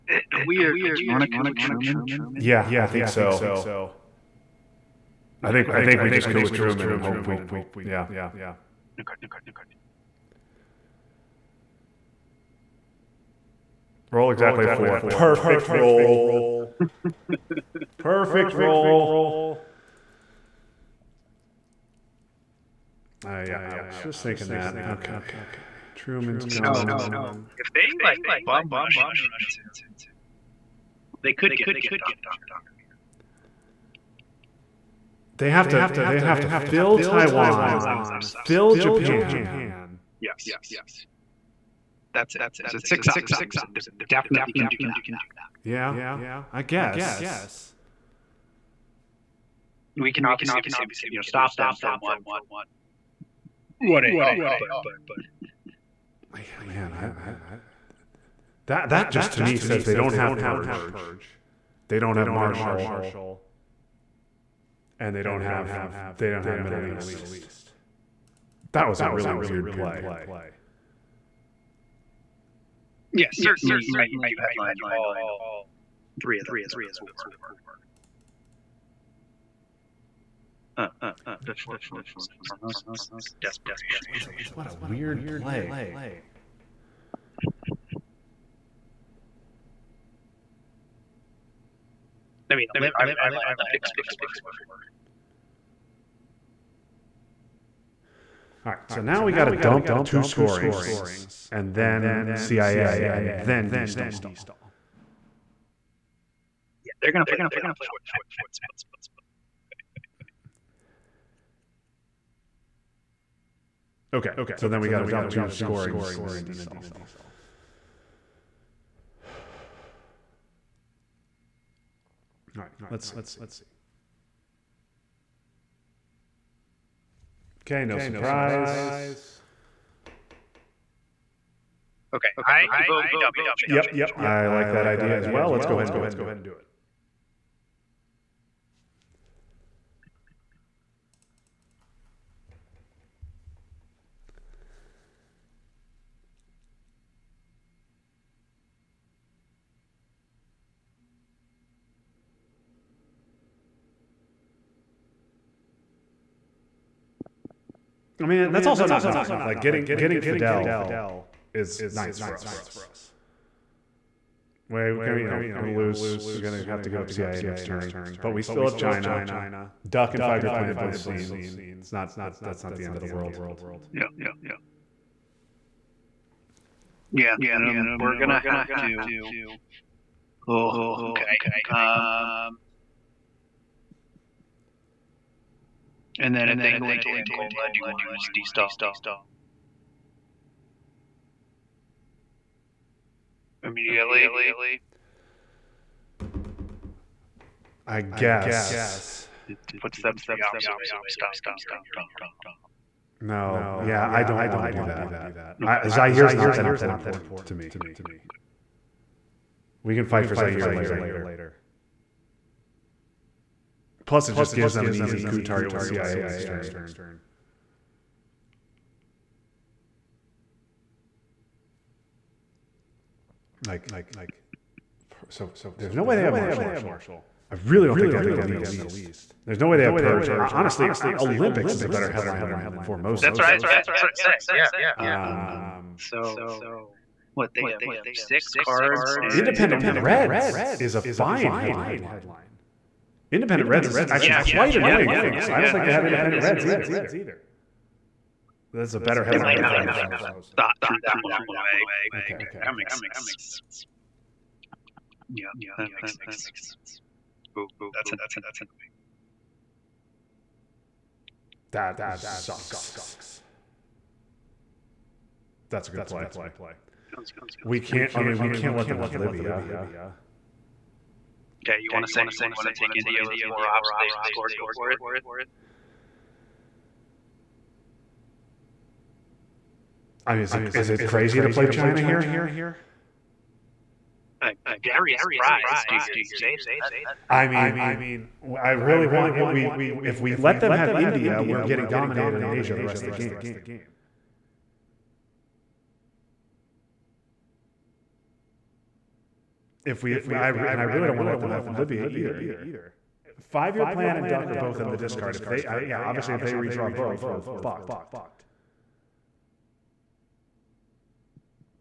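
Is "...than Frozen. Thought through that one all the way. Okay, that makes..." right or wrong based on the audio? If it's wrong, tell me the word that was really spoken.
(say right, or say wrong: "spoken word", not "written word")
right.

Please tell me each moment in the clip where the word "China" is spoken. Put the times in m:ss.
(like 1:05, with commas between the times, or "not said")
2:48, 4:41.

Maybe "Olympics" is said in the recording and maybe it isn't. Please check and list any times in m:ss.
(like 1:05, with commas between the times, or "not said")
1:33, 3:51.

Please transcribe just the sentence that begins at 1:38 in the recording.
All right, so now we got to dump two scorings, and then CIA, and then destall.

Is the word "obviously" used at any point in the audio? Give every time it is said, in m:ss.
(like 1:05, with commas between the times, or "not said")
0:50, 5:05.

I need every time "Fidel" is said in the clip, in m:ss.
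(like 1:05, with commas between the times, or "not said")
1:47, 2:40.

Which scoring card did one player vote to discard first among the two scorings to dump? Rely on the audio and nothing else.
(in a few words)
Age.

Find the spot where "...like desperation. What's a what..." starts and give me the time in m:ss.
1:23.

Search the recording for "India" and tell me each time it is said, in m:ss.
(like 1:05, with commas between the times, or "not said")
4:32, 4:50.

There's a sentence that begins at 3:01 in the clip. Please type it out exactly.
Um, And then if they go into Angola, do you want to just destall?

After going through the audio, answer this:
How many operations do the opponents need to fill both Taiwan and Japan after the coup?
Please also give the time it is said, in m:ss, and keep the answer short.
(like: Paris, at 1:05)
6, at 0:42.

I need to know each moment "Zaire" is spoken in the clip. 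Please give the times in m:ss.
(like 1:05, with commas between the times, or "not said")
3:25, 3:30.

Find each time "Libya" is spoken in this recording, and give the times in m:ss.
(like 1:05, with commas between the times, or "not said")
4:29, 5:01.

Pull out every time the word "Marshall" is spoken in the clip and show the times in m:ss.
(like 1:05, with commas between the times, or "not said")
1:02, 3:46.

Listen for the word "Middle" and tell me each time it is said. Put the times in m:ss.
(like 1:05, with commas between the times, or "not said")
1:06, 3:48.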